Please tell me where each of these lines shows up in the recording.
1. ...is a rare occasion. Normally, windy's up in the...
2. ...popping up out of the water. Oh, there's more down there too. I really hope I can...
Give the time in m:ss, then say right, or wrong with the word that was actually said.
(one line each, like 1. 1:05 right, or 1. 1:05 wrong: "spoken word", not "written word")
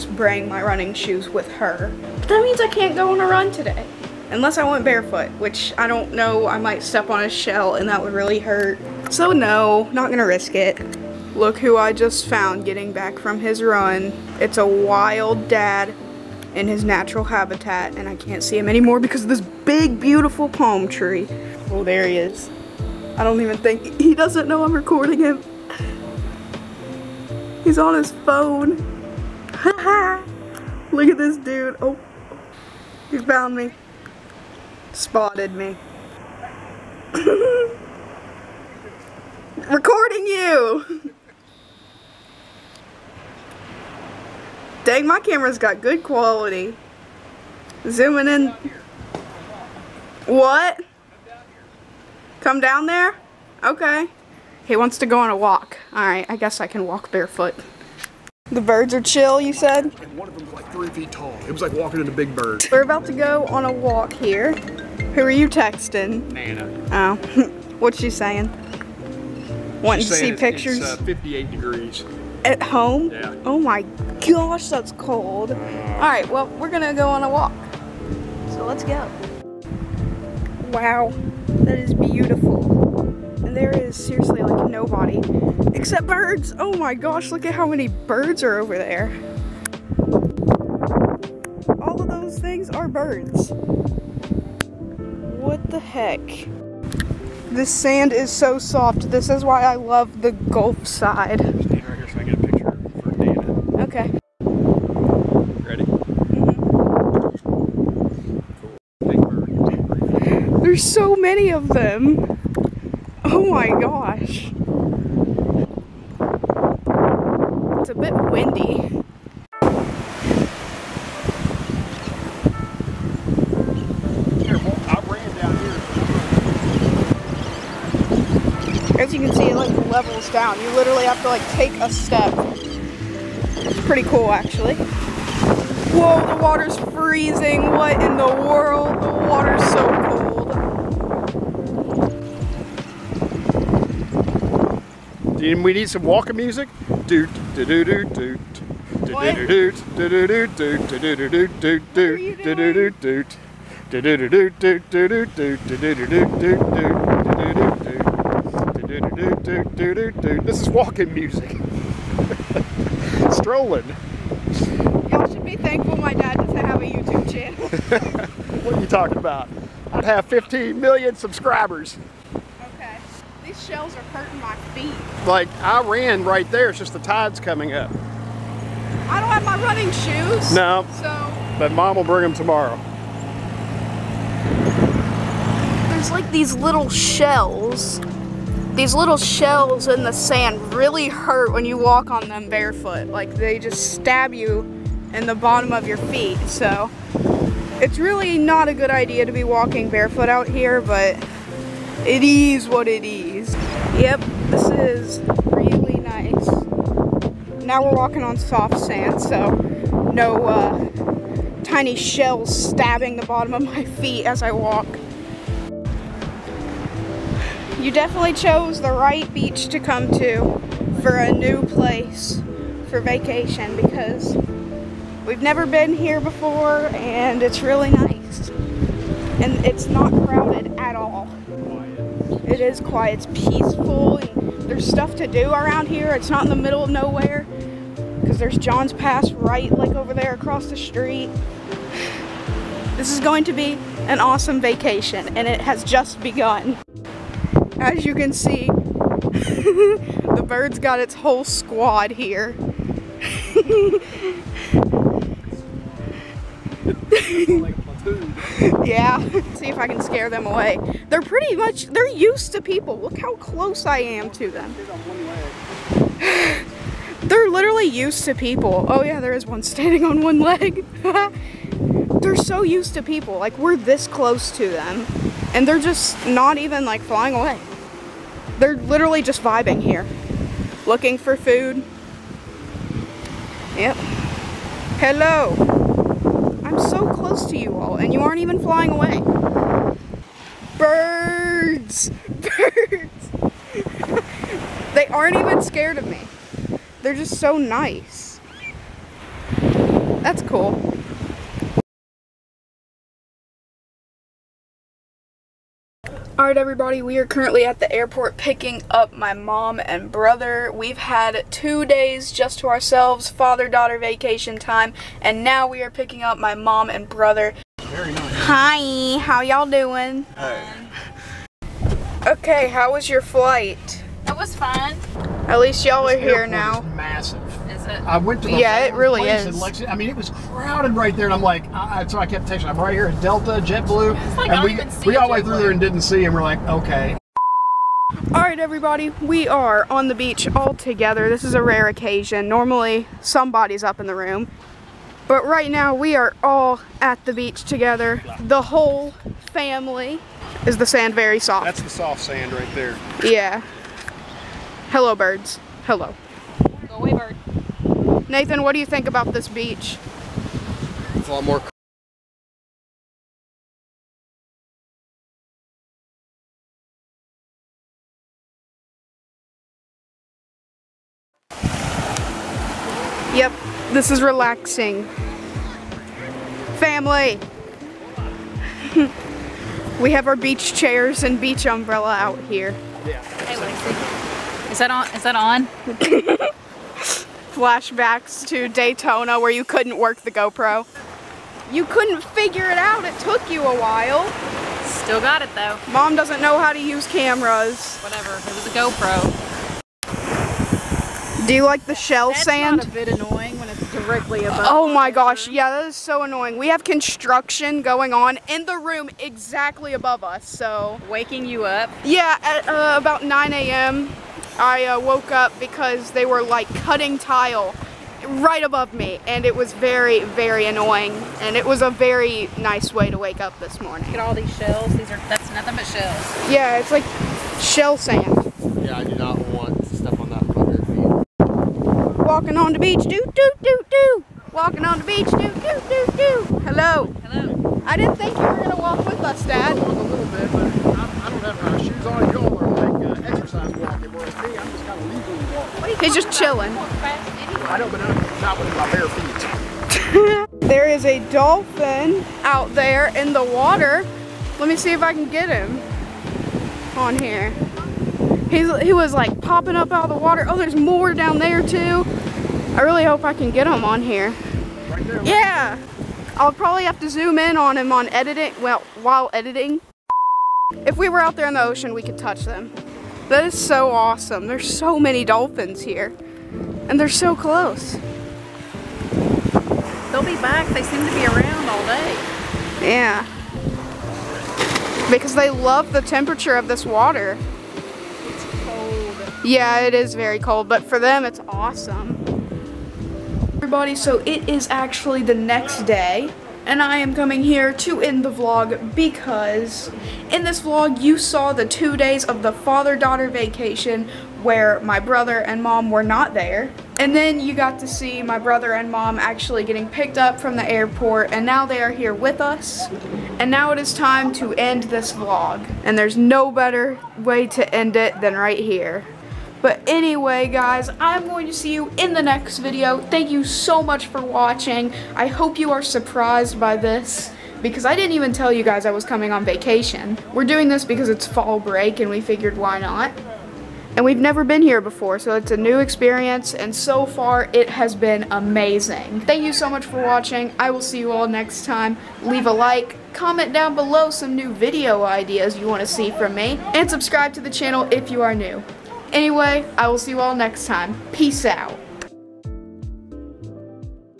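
1. 5:41 wrong: "somebody", not "windy"
2. 7:39 right.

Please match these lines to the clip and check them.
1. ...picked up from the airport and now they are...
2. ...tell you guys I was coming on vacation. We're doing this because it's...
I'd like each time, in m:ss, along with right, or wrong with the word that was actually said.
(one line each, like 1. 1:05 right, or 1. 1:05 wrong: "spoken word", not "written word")
1. 8:29 right
2. 8:48 right.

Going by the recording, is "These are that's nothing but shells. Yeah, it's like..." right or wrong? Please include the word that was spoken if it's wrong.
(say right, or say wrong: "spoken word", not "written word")
right.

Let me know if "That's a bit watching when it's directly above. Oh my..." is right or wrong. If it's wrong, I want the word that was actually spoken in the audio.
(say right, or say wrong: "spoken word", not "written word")
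wrong: "annoying", not "watching".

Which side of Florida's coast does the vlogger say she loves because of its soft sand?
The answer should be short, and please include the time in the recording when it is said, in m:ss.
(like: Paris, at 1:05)
Gulf side, at 1:40.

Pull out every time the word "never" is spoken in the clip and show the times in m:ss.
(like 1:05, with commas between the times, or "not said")
3:45, 8:54.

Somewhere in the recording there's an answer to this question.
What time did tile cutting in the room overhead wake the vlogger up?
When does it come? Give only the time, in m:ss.
6:53.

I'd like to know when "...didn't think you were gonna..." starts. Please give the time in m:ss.
7:17.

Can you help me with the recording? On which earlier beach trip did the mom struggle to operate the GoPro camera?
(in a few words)
Daytona.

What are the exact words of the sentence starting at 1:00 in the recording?
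one of them's like three feet tall.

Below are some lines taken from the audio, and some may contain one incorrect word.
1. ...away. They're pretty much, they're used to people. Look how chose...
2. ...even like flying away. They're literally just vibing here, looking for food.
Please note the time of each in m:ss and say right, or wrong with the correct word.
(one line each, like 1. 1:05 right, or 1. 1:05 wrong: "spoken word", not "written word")
1. 4:20 wrong: "close", not "chose"
2. 4:36 right.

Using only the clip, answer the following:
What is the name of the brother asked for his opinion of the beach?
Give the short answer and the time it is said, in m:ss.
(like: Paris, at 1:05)
Nathan, at 5:58.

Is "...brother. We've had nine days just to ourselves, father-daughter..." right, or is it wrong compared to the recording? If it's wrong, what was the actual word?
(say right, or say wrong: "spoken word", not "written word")
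wrong: "two", not "nine".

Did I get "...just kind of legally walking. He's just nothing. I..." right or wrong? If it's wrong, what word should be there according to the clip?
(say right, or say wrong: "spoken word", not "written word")
wrong: "chilling", not "nothing".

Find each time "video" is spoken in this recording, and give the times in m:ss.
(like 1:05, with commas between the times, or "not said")
8:42, 9:04.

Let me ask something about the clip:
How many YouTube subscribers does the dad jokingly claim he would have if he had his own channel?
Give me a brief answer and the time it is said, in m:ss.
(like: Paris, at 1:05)
15 million, at 2:50.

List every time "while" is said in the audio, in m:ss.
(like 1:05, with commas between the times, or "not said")
6:33, 7:49.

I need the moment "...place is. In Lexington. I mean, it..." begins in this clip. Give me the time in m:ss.
5:29.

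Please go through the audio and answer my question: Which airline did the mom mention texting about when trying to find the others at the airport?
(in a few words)
Delta.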